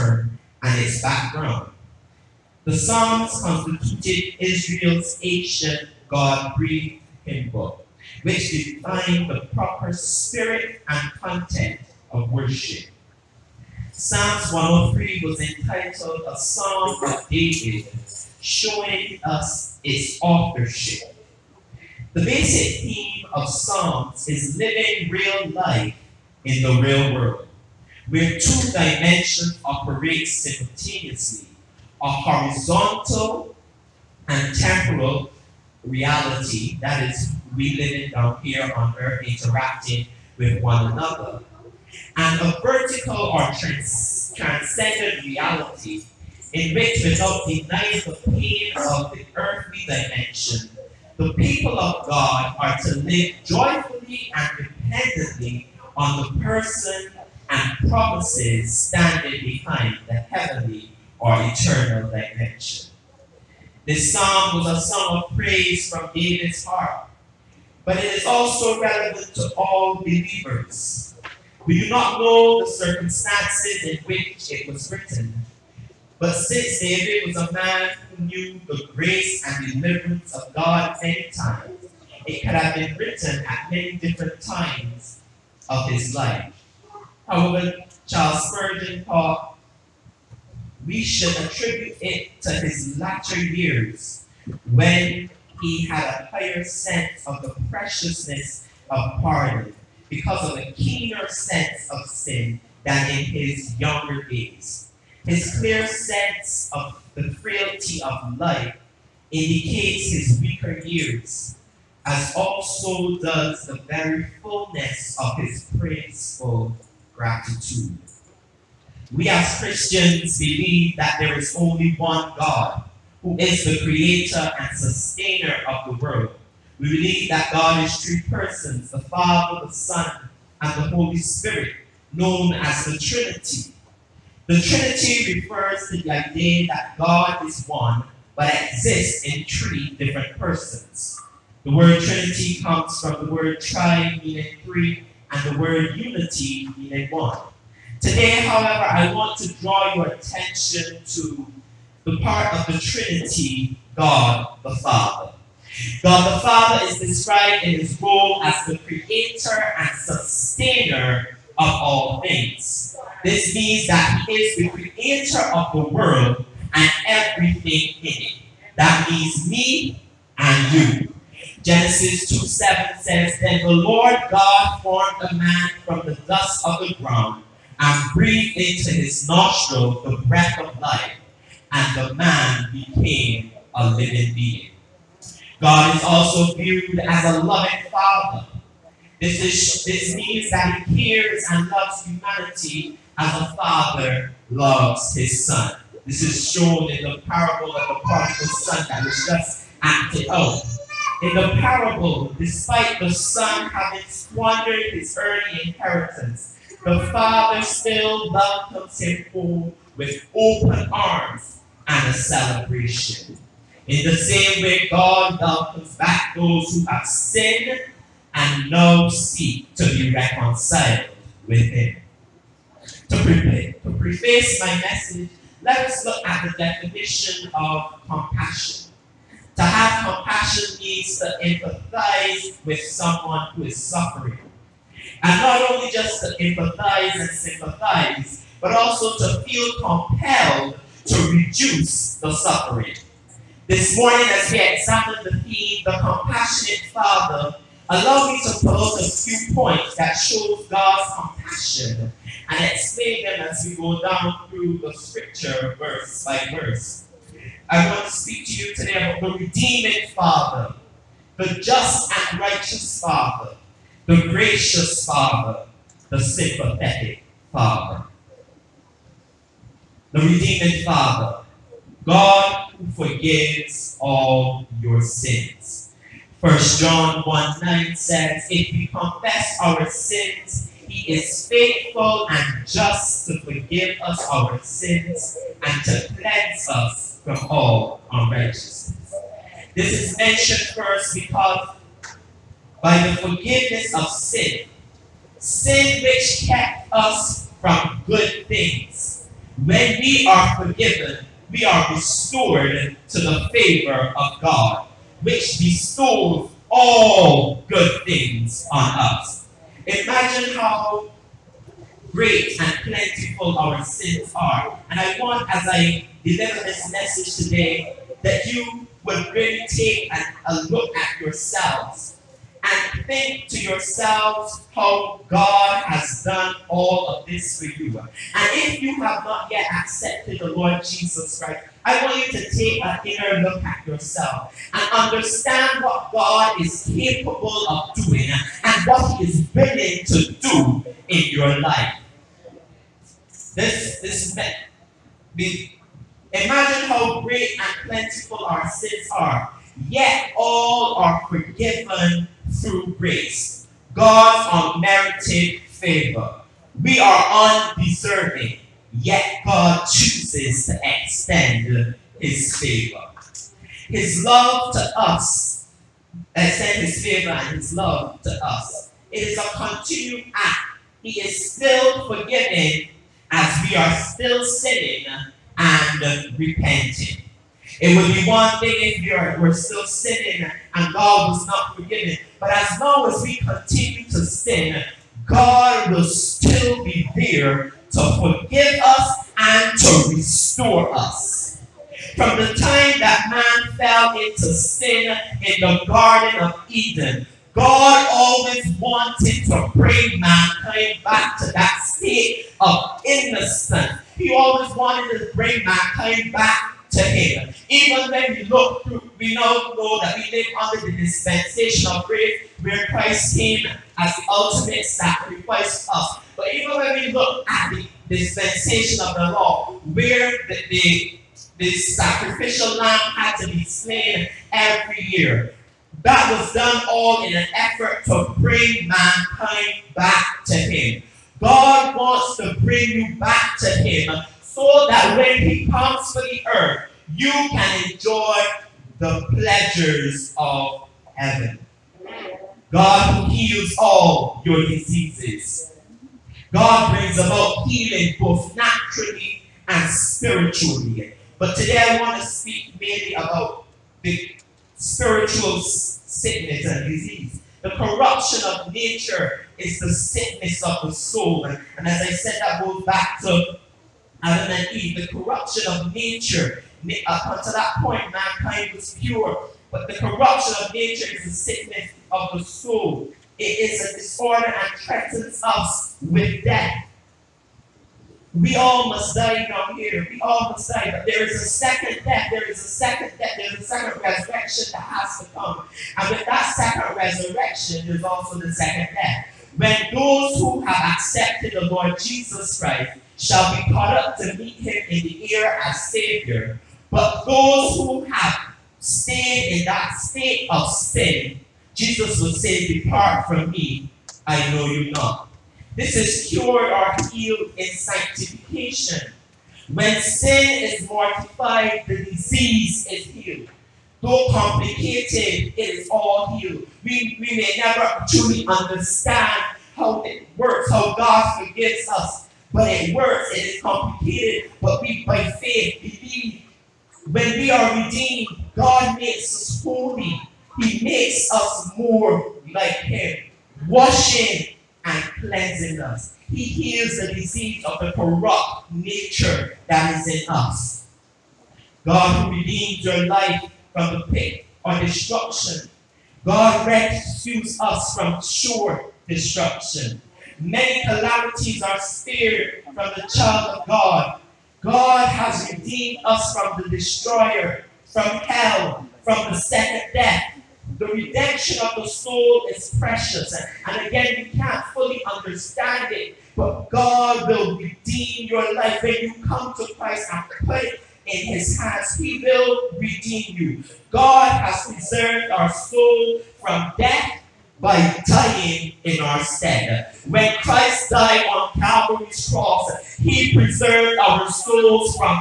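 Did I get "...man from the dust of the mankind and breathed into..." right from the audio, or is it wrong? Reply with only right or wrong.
wrong.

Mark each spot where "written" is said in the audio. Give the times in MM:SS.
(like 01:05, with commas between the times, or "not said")
01:14, 01:22.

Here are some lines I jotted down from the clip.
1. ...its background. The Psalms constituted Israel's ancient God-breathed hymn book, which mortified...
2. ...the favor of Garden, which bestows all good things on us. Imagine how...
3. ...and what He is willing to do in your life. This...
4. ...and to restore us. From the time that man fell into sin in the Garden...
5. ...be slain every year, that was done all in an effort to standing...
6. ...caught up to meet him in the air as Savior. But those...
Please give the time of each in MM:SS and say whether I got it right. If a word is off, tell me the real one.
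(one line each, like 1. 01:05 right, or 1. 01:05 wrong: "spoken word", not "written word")
1. 00:00 wrong: "defined", not "mortified"
2. 05:03 wrong: "God", not "Garden"
3. 05:38 right
4. 06:29 right
5. 07:03 wrong: "bring", not "standing"
6. 08:13 right.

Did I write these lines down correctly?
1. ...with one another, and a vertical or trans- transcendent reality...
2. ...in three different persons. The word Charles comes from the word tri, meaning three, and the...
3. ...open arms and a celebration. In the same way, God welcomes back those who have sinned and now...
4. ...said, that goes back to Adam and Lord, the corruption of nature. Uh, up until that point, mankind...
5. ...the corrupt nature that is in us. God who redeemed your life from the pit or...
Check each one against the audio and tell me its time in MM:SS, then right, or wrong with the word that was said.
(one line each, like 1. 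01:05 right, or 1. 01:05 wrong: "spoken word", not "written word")
1. 00:40 right
2. 02:19 wrong: "Trinity", not "Charles"
3. 03:30 right
4. 07:42 wrong: "Eve", not "Lord"
5. 08:57 right.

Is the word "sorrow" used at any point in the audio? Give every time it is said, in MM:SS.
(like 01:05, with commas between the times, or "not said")
not said.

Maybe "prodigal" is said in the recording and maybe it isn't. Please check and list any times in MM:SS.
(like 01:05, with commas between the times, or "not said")
03:18.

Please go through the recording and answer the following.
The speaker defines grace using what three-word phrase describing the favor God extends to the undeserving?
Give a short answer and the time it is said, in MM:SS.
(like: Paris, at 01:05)
God's unmerited favor, at 05:53.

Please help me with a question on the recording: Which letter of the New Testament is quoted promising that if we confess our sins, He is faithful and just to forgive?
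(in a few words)
First John.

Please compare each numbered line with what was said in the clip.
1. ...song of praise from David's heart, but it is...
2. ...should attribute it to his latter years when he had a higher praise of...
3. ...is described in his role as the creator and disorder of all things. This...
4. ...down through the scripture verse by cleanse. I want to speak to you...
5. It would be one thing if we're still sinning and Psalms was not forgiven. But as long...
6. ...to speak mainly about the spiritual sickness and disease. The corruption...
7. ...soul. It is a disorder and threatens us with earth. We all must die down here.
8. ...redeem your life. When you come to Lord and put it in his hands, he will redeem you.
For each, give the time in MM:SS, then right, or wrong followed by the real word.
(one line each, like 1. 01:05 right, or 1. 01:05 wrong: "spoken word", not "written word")
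1. 01:04 right
2. 01:31 wrong: "sense", not "praise"
3. 02:36 wrong: "sustainer", not "disorder"
4. 04:13 wrong: "verse", not "cleanse"
5. 06:17 wrong: "God", not "Psalms"
6. 07:32 right
7. 07:52 wrong: "death", not "earth"
8. 09:27 wrong: "Christ", not "Lord".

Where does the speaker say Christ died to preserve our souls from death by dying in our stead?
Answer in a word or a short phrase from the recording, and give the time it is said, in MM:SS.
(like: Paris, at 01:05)
Calvary's cross, at 09:41.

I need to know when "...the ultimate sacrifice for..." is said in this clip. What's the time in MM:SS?
06:54.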